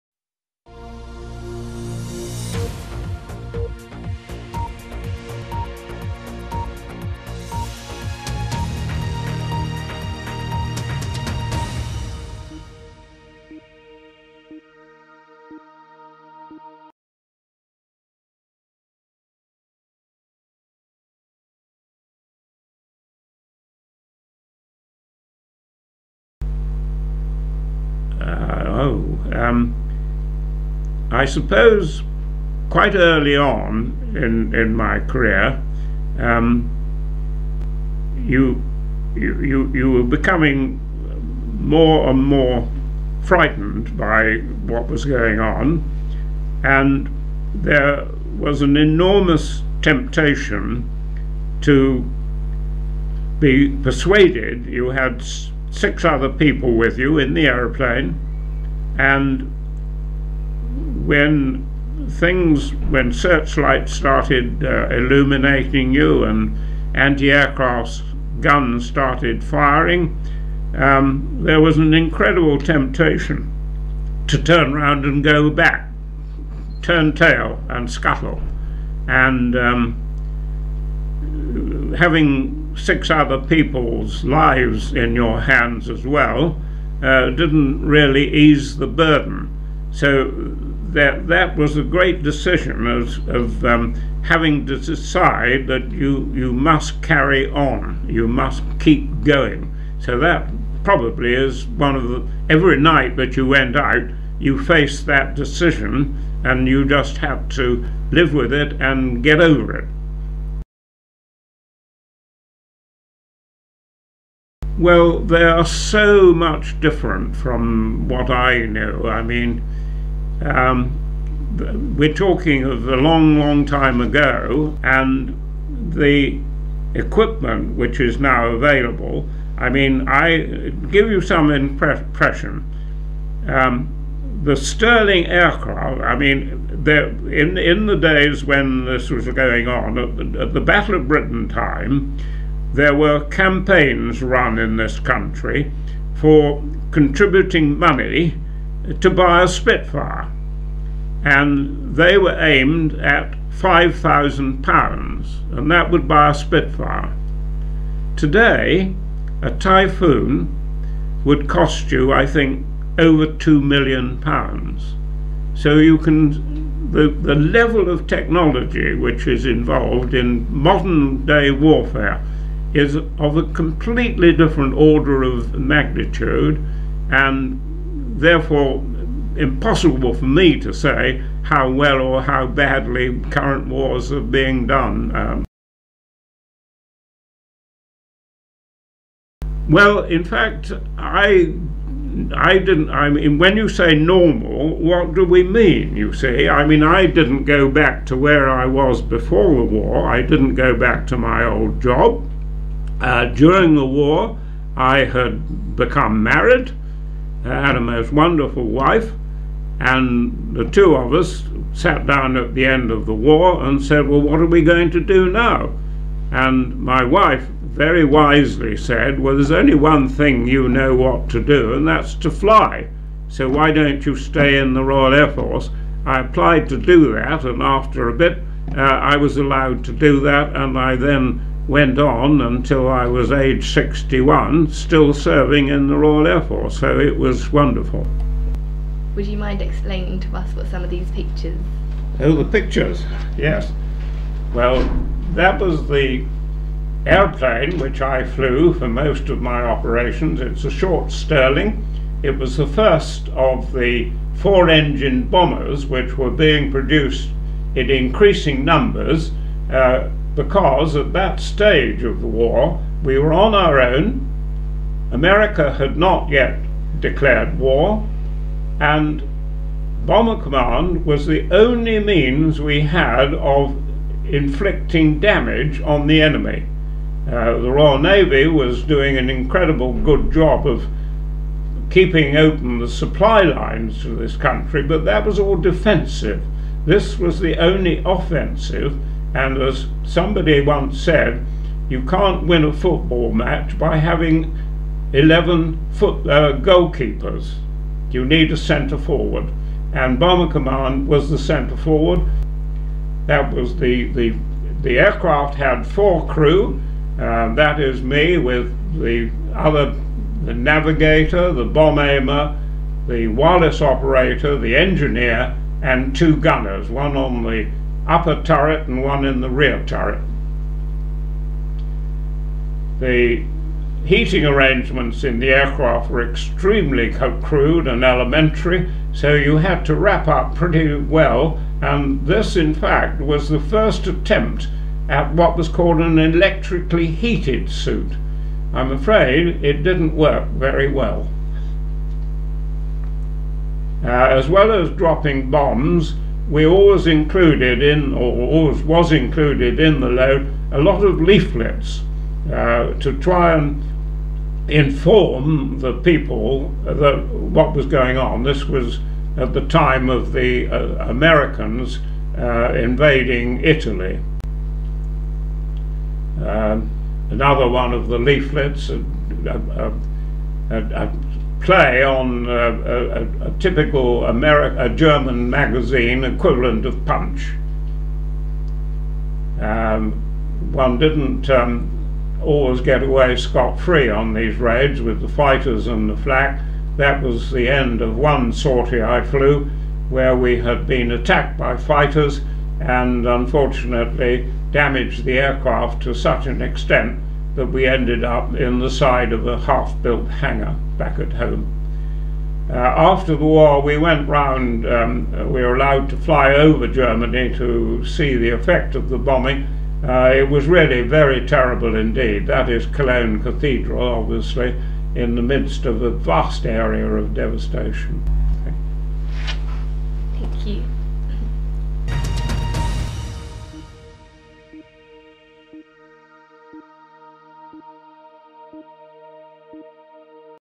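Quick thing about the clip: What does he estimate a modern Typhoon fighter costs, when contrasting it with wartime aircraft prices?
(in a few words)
over £2 million.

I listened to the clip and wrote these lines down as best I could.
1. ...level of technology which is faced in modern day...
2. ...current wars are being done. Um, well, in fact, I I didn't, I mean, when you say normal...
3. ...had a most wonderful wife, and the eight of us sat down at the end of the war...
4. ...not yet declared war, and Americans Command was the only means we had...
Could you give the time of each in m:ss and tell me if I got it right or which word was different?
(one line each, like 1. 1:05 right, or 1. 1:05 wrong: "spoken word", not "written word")
1. 2:47 wrong: "involved", not "faced"
2. 3:03 right
3. 3:27 wrong: "two", not "eight"
4. 4:25 wrong: "Bomber", not "Americans".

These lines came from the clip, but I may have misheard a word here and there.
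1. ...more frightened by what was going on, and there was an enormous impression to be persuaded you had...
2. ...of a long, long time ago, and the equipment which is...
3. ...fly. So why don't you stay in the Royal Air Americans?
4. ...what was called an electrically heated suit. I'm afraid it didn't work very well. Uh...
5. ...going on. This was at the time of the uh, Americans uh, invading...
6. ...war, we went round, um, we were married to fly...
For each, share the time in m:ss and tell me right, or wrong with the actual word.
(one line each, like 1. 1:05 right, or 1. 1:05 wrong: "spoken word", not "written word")
1. 0:42 wrong: "temptation", not "impression"
2. 2:02 right
3. 3:42 wrong: "Force", not "Americans"
4. 5:35 right
5. 5:57 right
6. 6:43 wrong: "allowed", not "married".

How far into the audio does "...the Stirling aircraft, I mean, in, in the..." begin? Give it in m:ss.
2:14.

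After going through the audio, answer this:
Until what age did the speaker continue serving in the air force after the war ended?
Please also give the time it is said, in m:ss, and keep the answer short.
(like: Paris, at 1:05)
61, at 3:53.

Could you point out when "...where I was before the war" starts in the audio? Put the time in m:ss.
3:18.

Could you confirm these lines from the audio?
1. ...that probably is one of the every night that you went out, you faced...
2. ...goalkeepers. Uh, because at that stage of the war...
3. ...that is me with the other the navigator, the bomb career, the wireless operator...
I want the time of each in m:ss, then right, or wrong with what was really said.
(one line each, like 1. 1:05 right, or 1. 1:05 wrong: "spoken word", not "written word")
1. 1:40 right
2. 4:18 wrong: "numbers", not "goalkeepers"
3. 5:07 wrong: "aimer", not "career".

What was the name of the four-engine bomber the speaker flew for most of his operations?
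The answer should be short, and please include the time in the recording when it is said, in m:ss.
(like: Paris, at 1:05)
Short Stirling, at 4:10.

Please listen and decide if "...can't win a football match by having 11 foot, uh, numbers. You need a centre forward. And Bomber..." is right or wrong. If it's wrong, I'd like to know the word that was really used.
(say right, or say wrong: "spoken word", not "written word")
wrong: "goalkeepers", not "numbers".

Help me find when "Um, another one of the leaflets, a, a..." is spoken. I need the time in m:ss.
6:06.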